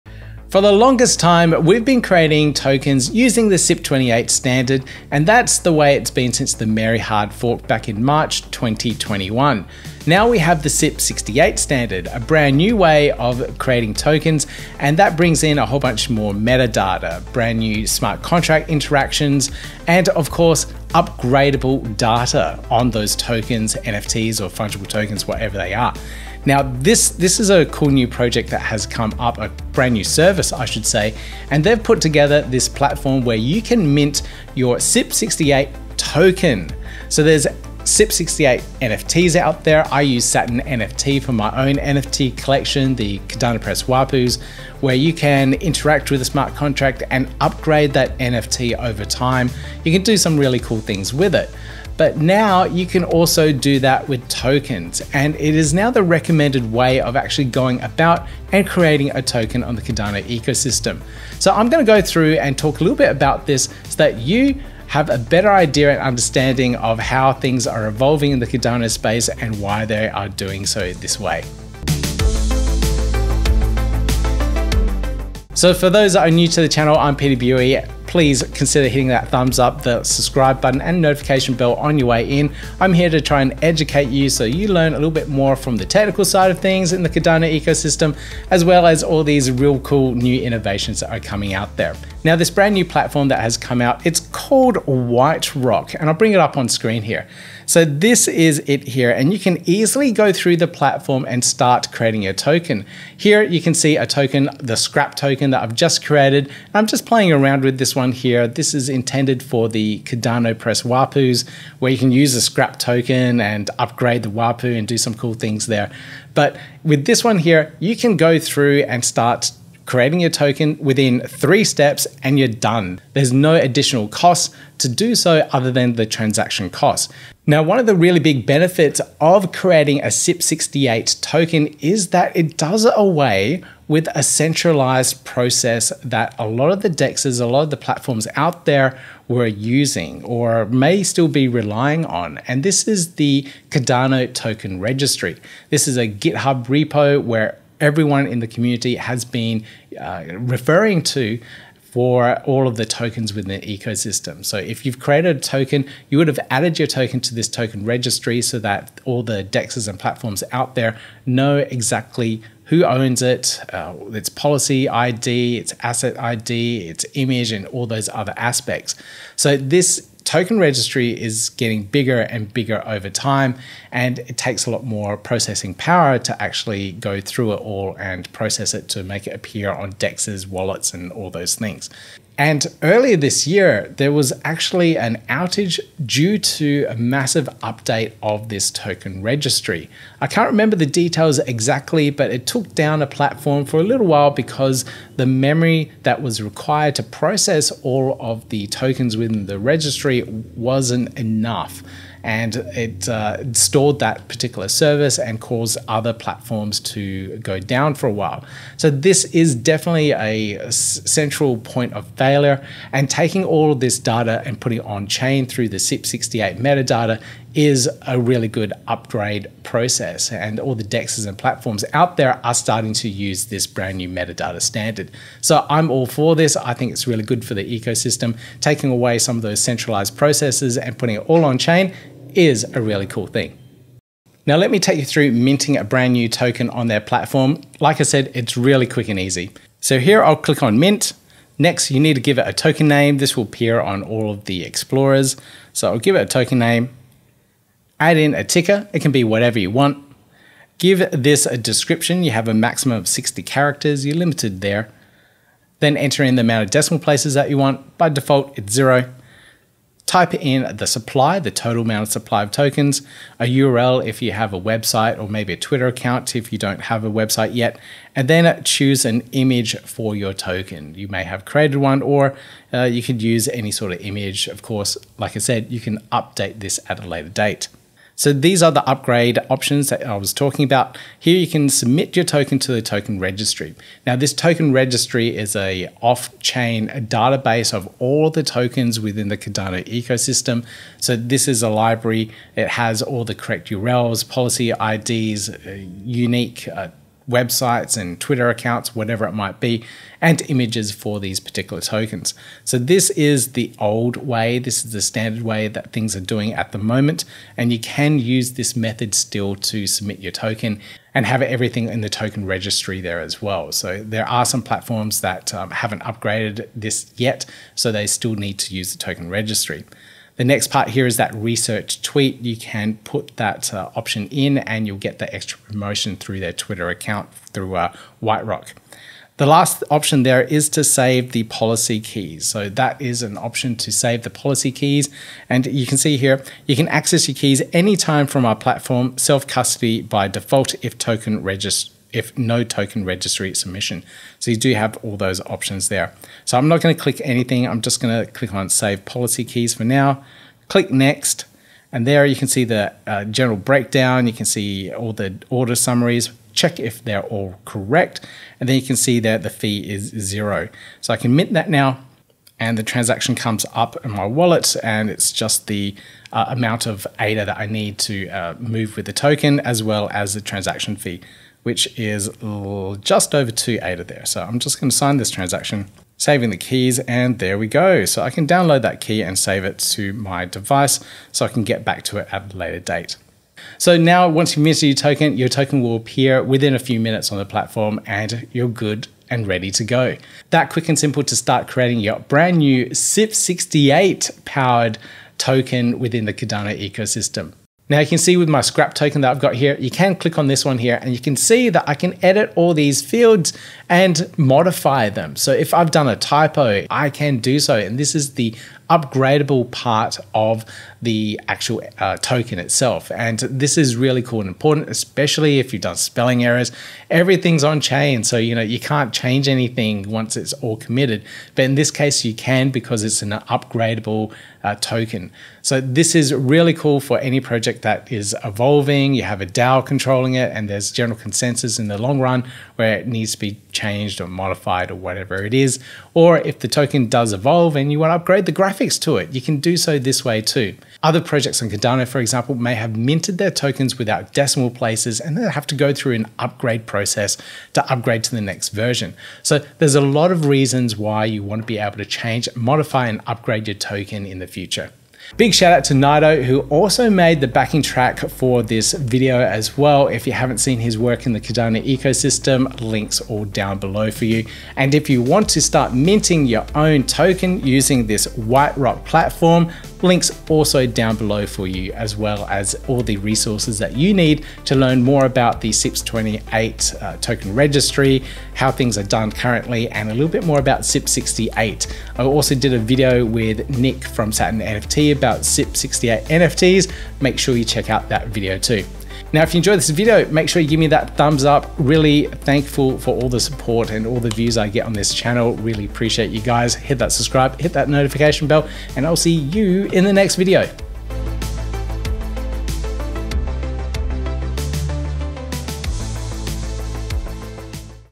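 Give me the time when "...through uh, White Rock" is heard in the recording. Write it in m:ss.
5:27.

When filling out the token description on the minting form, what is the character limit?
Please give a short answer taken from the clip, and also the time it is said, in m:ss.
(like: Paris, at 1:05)
60, at 4:13.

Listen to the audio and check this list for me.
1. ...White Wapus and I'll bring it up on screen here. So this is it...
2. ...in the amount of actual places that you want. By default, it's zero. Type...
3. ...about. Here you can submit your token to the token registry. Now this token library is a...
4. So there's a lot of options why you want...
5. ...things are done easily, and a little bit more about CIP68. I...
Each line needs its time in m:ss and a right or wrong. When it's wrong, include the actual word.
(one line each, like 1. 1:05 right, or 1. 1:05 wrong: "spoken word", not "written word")
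1. 1:34 wrong: "Rock", not "Wapus"
2. 4:16 wrong: "decimal", not "actual"
3. 4:40 wrong: "registry", not "library"
4. 7:29 wrong: "reasons", not "options"
5. 7:58 wrong: "currently", not "easily".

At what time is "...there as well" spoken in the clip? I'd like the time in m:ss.
5:13.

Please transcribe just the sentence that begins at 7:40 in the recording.
If you haven't seen his work in the Cardano ecosystem, links all down below for you.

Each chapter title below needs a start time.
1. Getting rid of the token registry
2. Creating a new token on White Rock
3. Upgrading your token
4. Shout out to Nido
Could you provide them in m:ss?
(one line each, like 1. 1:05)
1. 2:07
2. 3:53
3. 6:37
4. 7:34.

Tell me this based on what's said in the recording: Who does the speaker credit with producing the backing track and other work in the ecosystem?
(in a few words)
Nido.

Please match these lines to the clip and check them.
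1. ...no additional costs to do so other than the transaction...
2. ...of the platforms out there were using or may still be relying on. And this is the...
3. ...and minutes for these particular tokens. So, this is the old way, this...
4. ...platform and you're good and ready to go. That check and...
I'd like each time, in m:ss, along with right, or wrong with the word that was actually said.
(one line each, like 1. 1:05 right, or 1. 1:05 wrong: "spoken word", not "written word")
1. 2:03 right
2. 2:17 right
3. 5:00 wrong: "images", not "minutes"
4. 6:27 wrong: "quick", not "check".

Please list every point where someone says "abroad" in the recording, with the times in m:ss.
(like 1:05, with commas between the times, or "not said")
not said.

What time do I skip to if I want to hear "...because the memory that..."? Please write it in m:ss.
3:14.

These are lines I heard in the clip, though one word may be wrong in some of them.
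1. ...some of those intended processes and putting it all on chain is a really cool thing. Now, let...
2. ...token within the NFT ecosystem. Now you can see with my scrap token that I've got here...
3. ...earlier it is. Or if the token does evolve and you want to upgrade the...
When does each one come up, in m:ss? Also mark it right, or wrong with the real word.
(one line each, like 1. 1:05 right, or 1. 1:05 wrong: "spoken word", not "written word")
1. 3:49 wrong: "centralized", not "intended"
2. 6:35 wrong: "Cardano", not "NFT"
3. 7:14 wrong: "whatever", not "earlier".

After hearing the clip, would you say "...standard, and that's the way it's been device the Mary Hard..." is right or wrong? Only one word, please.
wrong.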